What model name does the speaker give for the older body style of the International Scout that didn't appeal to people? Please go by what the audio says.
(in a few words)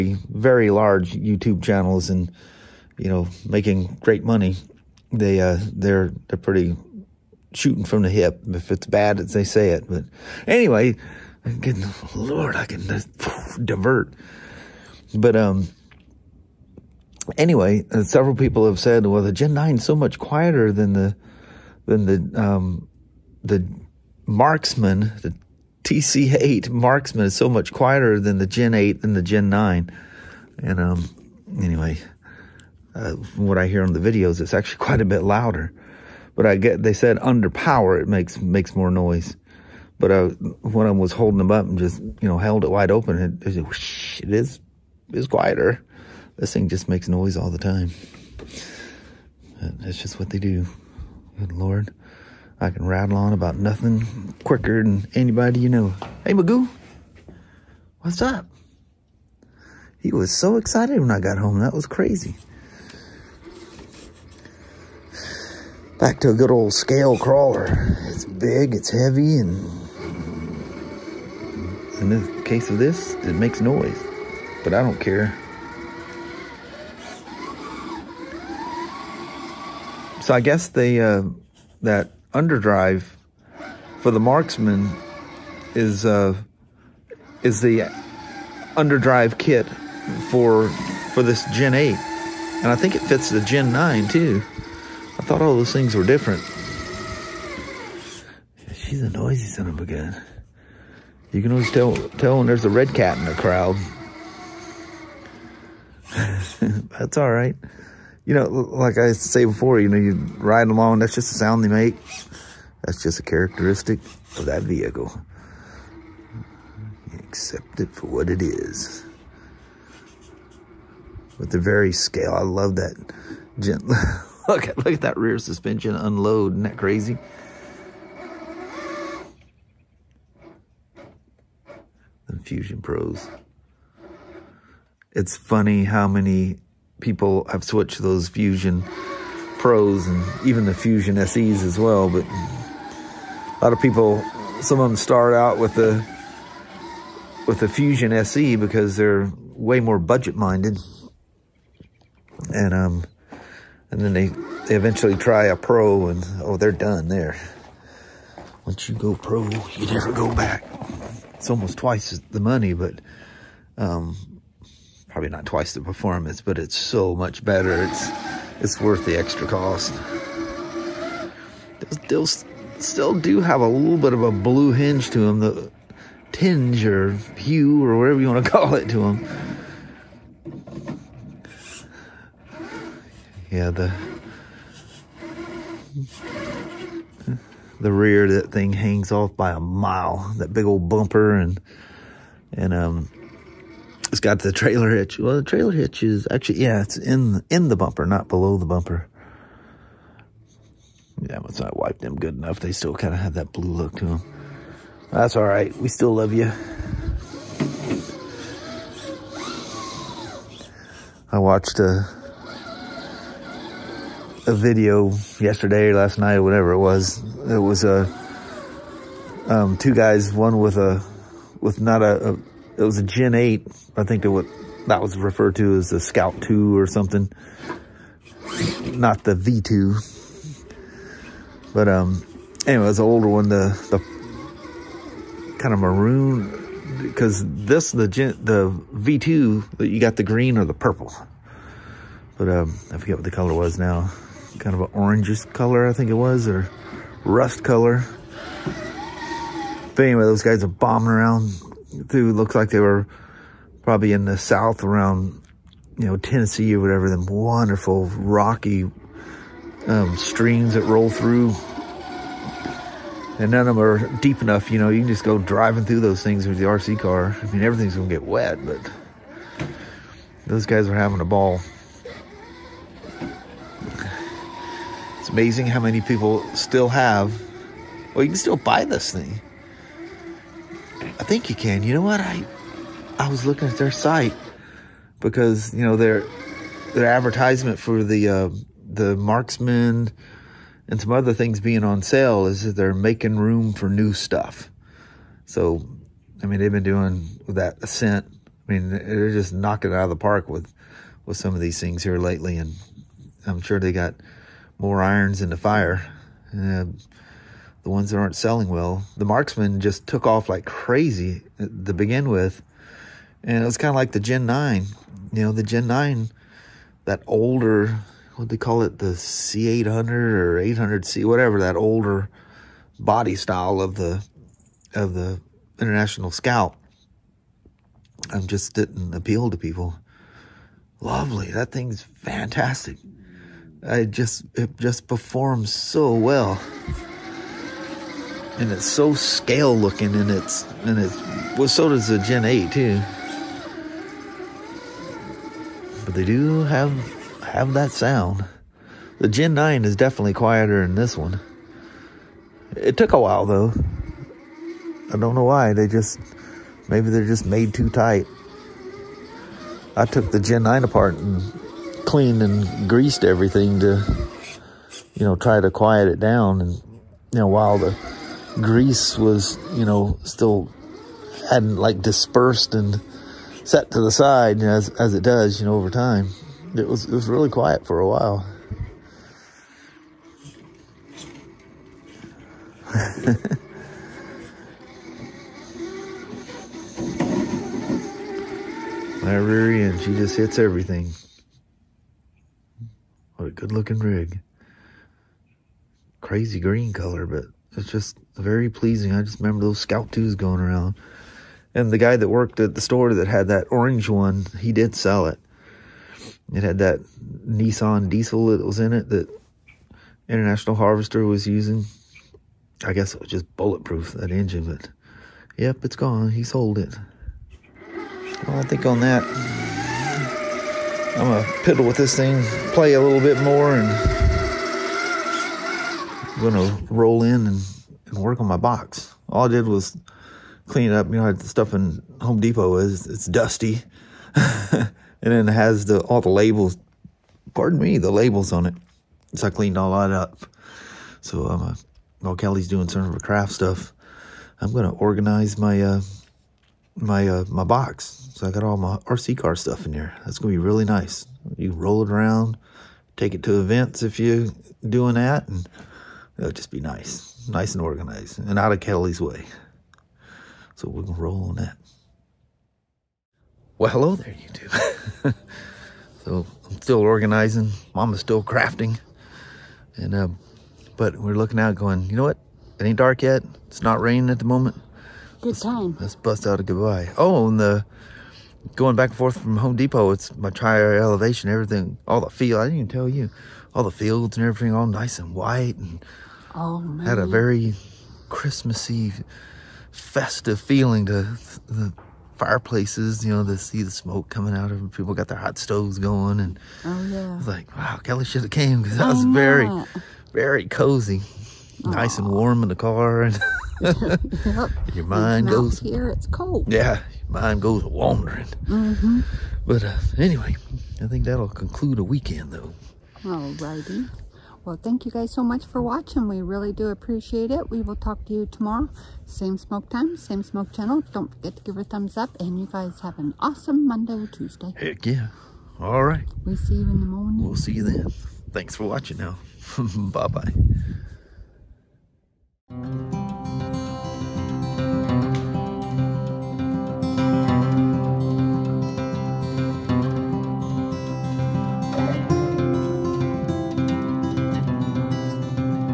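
C800.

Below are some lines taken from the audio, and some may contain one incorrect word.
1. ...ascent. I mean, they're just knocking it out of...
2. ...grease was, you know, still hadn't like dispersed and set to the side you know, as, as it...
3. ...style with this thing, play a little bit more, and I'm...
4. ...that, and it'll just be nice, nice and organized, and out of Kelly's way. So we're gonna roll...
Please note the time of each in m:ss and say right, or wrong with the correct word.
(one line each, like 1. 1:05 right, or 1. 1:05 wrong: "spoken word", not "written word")
1. 4:57 right
2. 6:08 right
3. 7:01 wrong: "piddle", not "style"
4. 7:35 right.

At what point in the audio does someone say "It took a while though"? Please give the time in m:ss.
5:52.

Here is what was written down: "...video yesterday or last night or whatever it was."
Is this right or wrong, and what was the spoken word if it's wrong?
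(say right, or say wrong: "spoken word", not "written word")
right.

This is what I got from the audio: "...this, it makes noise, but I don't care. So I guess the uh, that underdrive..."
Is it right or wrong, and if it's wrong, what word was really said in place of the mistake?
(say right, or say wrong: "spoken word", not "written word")
right.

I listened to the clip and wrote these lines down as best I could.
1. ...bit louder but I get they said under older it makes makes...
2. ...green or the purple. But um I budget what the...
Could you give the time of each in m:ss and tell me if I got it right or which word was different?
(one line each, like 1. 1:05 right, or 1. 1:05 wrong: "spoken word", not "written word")
1. 0:35 wrong: "power", not "older"
2. 4:00 wrong: "forget", not "budget".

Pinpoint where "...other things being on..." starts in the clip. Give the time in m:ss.
4:51.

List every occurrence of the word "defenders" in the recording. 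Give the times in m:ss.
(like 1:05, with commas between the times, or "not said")
not said.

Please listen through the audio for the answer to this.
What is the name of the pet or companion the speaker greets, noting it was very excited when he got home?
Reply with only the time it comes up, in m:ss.
0:56.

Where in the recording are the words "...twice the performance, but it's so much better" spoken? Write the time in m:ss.
2:45.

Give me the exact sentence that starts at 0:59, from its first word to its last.
He was so excited when I got home.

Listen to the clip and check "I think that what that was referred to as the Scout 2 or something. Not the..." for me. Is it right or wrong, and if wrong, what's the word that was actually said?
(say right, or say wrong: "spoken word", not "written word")
right.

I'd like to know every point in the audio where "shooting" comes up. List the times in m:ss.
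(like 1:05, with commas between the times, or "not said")
0:07.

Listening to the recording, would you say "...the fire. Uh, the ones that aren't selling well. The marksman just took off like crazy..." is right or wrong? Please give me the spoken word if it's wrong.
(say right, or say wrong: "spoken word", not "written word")
right.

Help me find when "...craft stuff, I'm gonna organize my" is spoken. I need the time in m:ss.
7:23.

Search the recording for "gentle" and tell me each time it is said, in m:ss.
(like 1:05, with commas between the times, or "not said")
2:03.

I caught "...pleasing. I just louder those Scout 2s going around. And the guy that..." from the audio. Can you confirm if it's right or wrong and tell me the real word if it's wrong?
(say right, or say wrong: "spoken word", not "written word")
wrong: "remember", not "louder".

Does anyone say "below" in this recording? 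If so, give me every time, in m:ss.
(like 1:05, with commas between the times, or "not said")
3:18.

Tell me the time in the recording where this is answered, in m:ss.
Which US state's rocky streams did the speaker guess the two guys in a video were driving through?
4:16.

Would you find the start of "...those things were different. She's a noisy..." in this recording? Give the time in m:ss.
1:35.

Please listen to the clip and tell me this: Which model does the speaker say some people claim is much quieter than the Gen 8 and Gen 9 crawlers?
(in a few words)
TC8 Marksman.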